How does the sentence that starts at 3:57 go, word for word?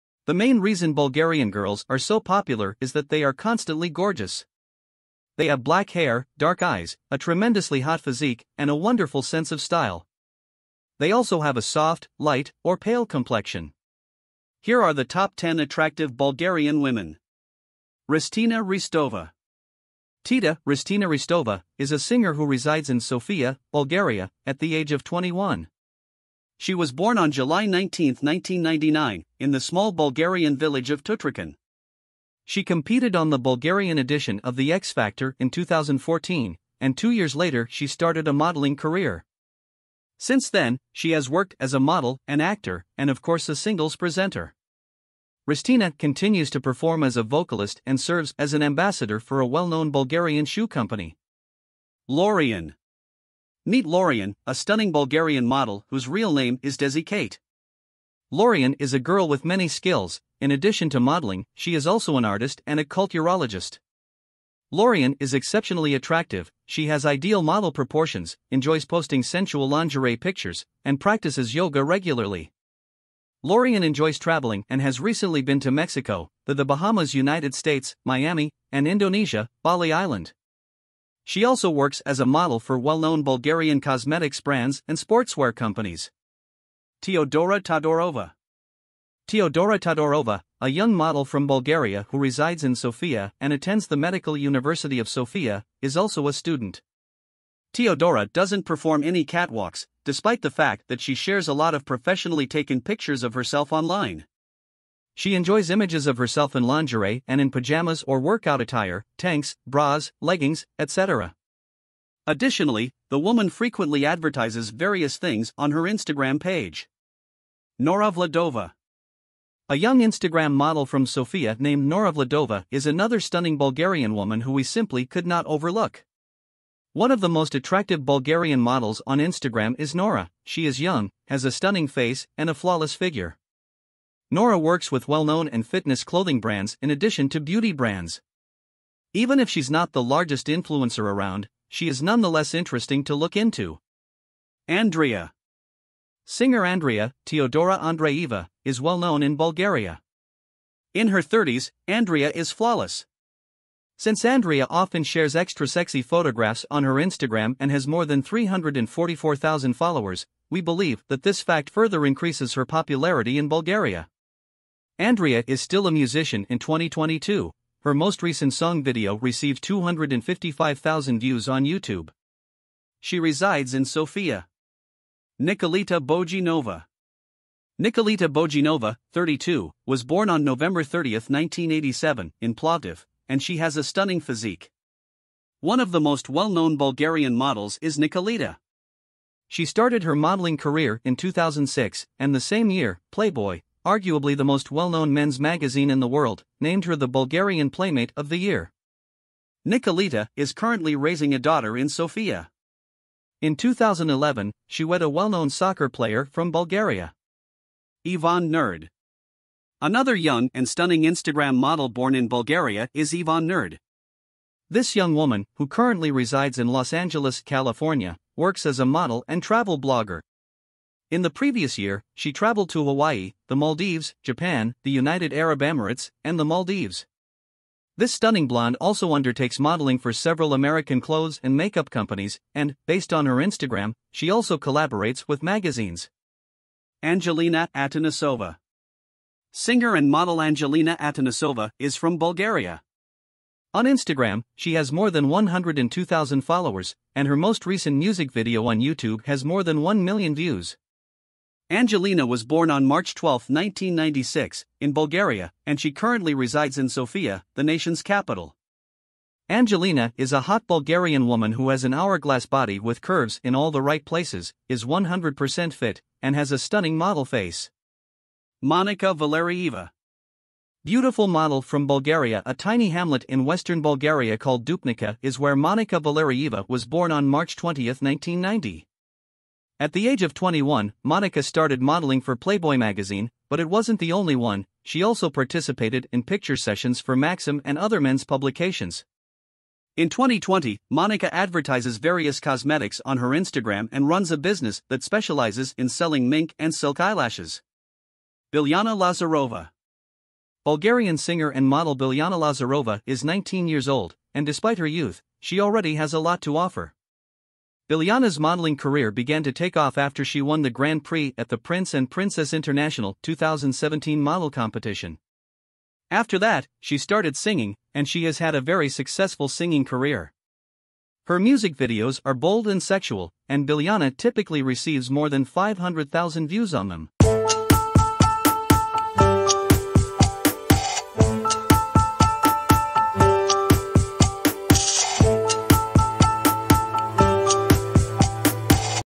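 Angelina Atanasova Singer and model Angelina Atanasova is from Bulgaria.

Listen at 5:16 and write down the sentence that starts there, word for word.
After that, she started singing, and she has had a very successful singing career.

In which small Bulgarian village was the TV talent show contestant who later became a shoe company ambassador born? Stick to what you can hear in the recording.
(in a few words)
Tutrakan.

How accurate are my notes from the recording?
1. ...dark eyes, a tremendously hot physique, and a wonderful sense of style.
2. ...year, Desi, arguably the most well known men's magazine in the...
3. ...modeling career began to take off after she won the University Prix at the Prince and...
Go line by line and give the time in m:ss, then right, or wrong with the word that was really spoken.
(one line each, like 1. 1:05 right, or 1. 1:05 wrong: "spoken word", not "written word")
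1. 0:06 right
2. 3:12 wrong: "Playboy", not "Desi"
3. 5:08 wrong: "Grand", not "University".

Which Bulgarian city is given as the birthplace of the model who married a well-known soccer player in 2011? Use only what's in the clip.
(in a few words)
Plovdiv.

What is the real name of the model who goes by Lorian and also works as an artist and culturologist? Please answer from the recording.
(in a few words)
Desi Kate.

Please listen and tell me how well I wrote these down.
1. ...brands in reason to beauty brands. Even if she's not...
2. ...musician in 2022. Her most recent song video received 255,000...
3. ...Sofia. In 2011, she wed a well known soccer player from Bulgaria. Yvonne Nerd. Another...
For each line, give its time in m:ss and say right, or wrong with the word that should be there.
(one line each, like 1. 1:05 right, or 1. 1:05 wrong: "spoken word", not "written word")
1. 2:16 wrong: "addition", not "reason"
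2. 2:45 right
3. 3:21 right.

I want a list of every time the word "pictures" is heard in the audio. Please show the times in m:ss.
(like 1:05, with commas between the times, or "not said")
1:10, 1:42, 4:46.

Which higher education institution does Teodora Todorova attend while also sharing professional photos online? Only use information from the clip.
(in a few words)
Medical University of Sofia.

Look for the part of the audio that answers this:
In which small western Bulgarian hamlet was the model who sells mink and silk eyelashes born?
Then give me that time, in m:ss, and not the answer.
4:34.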